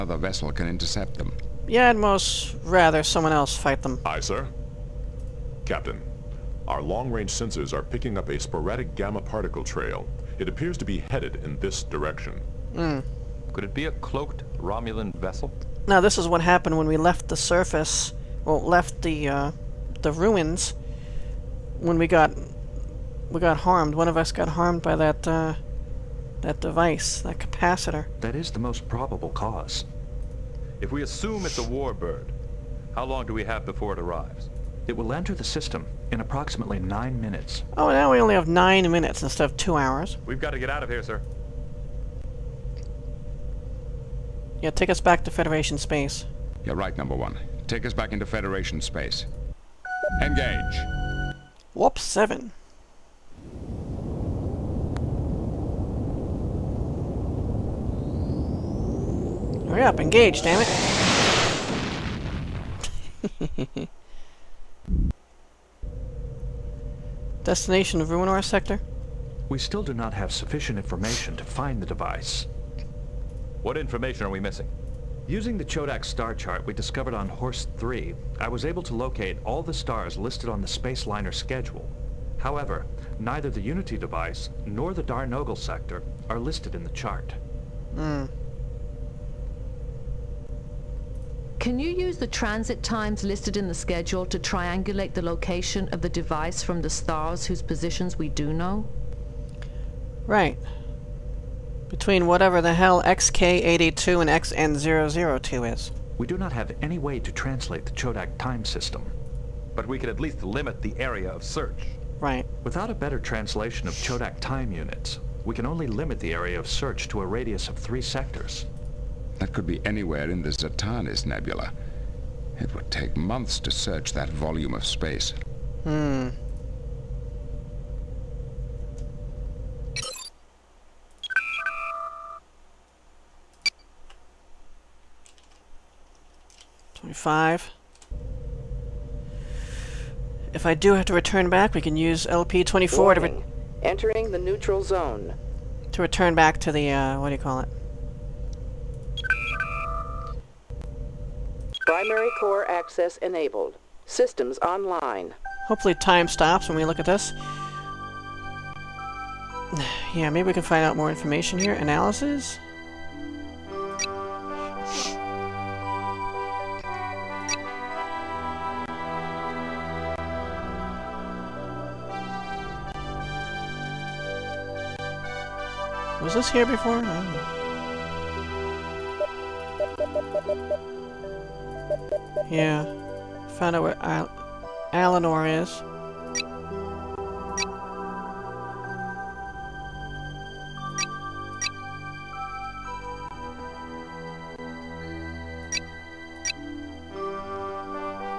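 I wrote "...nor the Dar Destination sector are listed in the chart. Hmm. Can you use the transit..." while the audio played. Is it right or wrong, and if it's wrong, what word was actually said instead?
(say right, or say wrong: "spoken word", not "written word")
wrong: "Nogel", not "Destination".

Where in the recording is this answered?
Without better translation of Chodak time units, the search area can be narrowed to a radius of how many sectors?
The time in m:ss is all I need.
1:57.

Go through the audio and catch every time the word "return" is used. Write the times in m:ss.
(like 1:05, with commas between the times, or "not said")
2:21, 2:26.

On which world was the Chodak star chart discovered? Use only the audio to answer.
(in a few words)
Horst 3.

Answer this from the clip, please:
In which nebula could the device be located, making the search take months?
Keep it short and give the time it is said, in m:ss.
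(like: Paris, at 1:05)
Zatanis Nebula, at 2:00.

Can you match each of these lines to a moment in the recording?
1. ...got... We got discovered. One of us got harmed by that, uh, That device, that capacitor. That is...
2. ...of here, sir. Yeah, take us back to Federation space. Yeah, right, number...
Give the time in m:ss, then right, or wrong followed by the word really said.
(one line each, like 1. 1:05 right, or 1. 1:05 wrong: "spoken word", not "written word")
1. 0:22 wrong: "harmed", not "discovered"
2. 0:40 right.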